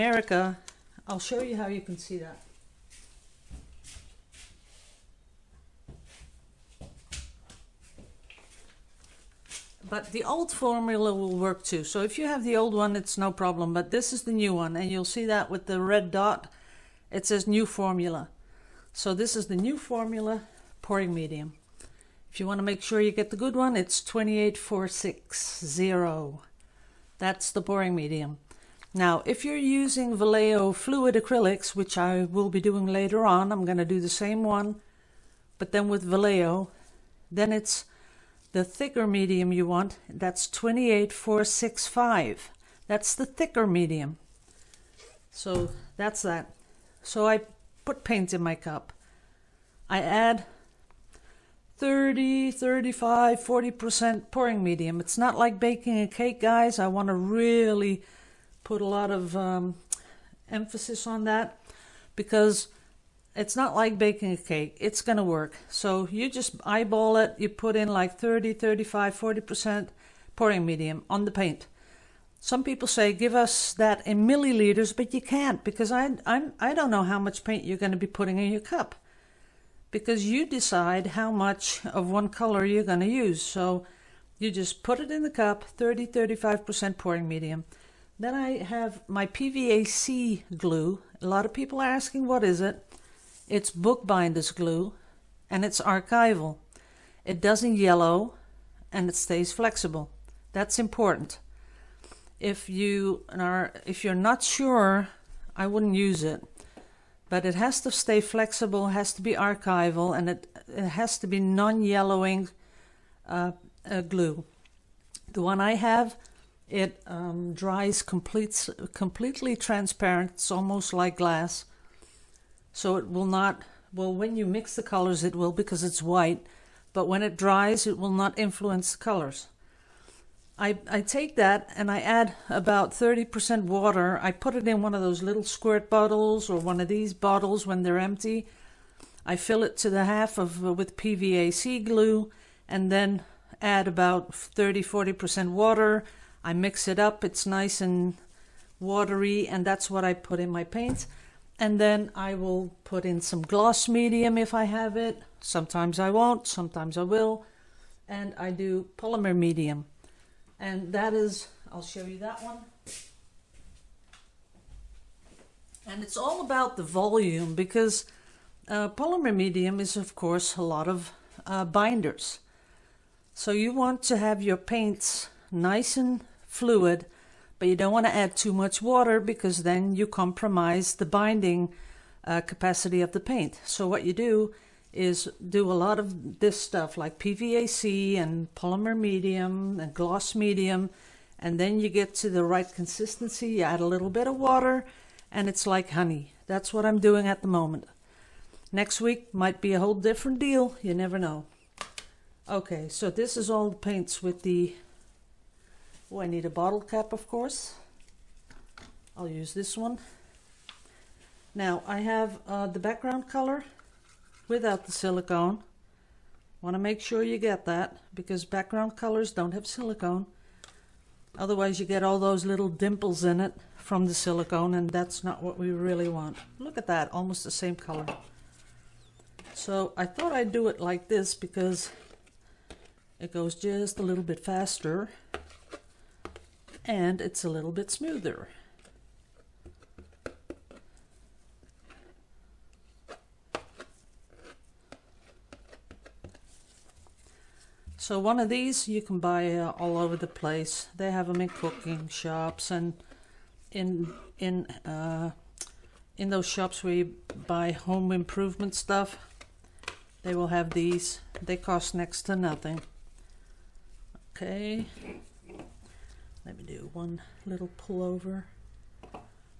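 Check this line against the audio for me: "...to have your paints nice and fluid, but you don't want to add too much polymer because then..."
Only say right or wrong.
wrong.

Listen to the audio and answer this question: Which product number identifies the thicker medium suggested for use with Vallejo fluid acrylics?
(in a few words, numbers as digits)
28465.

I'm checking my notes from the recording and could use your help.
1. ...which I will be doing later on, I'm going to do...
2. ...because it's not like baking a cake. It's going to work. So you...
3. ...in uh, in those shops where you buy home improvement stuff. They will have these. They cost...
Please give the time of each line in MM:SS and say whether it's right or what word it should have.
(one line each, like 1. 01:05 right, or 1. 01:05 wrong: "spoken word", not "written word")
1. 00:31 right
2. 01:02 right
3. 04:14 right.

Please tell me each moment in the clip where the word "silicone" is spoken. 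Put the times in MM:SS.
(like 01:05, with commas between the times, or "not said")
03:34, 03:39, 03:44.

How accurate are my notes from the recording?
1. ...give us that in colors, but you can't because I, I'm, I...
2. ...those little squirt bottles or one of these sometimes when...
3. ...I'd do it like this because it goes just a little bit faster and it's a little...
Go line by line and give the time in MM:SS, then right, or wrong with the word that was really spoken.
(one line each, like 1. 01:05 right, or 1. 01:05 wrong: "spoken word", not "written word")
1. 01:13 wrong: "milliliters", not "colors"
2. 02:15 wrong: "bottles", not "sometimes"
3. 03:50 right.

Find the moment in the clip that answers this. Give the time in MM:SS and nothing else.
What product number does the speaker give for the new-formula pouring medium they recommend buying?
00:24.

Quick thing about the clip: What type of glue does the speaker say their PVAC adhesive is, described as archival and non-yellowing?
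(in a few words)
bookbinder's glue.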